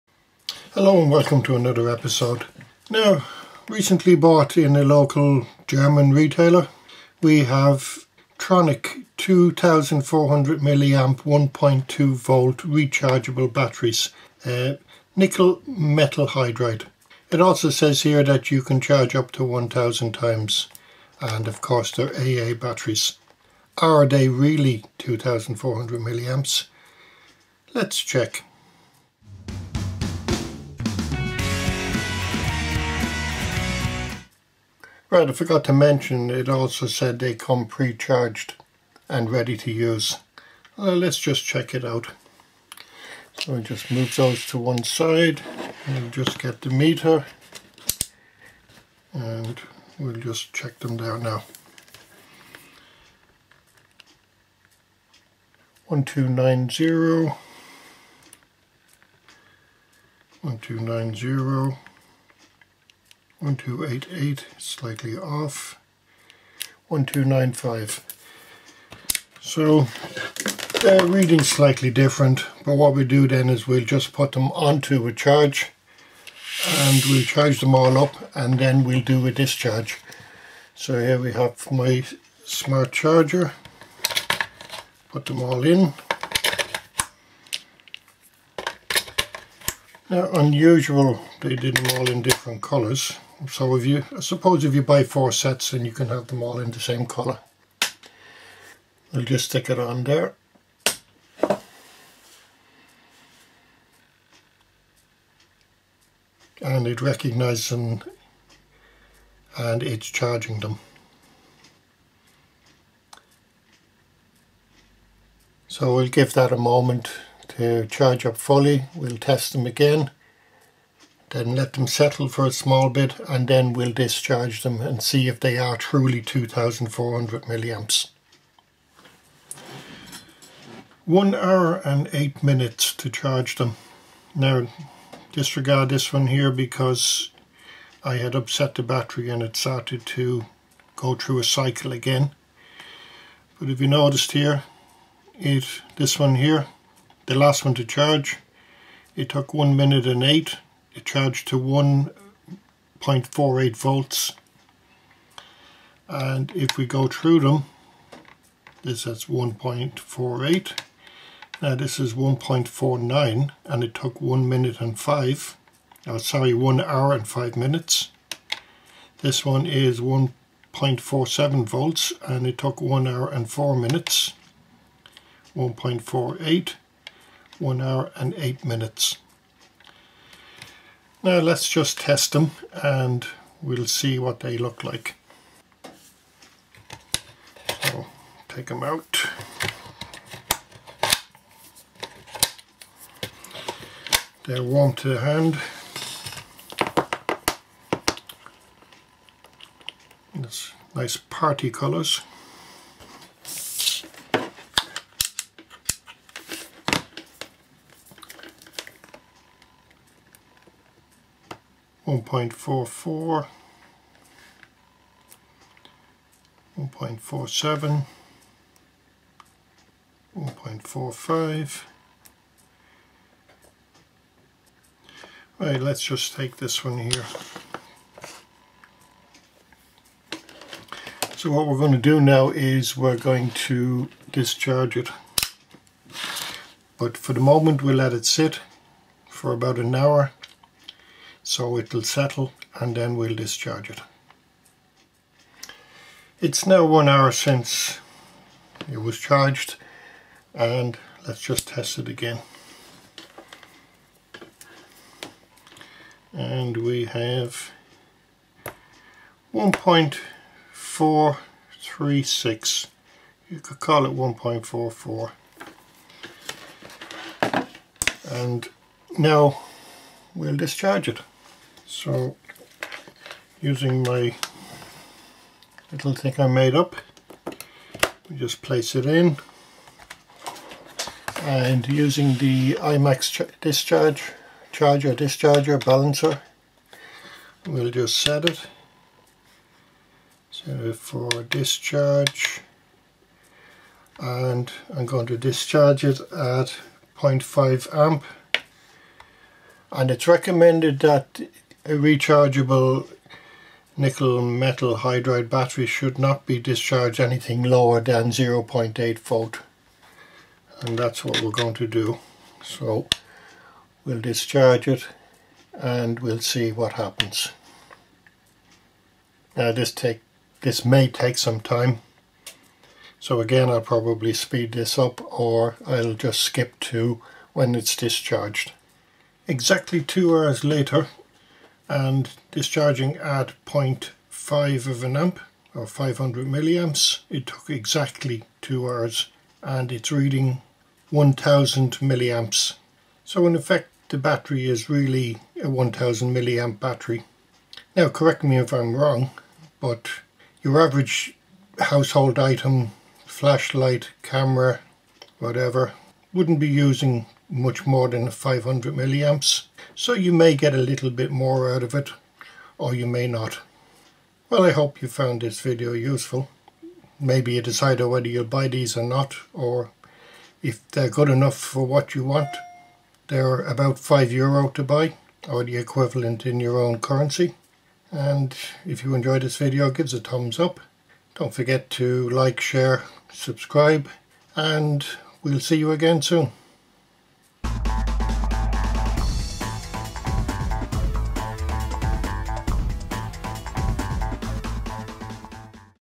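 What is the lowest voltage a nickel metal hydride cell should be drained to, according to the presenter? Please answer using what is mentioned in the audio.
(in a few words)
0.8 volt.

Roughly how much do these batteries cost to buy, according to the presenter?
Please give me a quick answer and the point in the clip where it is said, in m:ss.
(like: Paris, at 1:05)
€5, at 6:13.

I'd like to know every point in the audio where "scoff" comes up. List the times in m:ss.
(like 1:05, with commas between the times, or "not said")
not said.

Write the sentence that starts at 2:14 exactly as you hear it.
Now disregard this one here because I had upset the battery and it started to go through a cycle again.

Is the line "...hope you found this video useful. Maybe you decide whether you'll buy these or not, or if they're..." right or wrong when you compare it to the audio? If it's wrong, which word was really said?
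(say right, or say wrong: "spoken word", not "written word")
right.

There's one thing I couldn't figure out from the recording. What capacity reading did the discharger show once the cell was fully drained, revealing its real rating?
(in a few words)
1000 milliamps.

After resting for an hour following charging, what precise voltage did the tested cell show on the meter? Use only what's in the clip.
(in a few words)
1.436.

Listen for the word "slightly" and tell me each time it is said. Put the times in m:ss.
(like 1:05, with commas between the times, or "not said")
1:04, 1:11.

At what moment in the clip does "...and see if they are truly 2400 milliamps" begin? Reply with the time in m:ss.
2:04.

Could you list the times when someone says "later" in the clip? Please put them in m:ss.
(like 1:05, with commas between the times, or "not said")
5:30.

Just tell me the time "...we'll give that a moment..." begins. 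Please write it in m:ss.
1:55.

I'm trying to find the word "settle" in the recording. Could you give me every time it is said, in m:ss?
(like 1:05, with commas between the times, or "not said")
2:01, 4:02.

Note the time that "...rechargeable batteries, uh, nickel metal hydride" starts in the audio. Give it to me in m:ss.
0:12.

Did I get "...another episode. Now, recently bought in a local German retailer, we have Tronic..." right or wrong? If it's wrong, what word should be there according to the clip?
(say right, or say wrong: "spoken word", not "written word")
right.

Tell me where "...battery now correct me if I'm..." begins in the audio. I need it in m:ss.
5:46.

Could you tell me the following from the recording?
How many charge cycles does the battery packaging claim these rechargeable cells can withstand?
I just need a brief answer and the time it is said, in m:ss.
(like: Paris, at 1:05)
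1000 times, at 0:19.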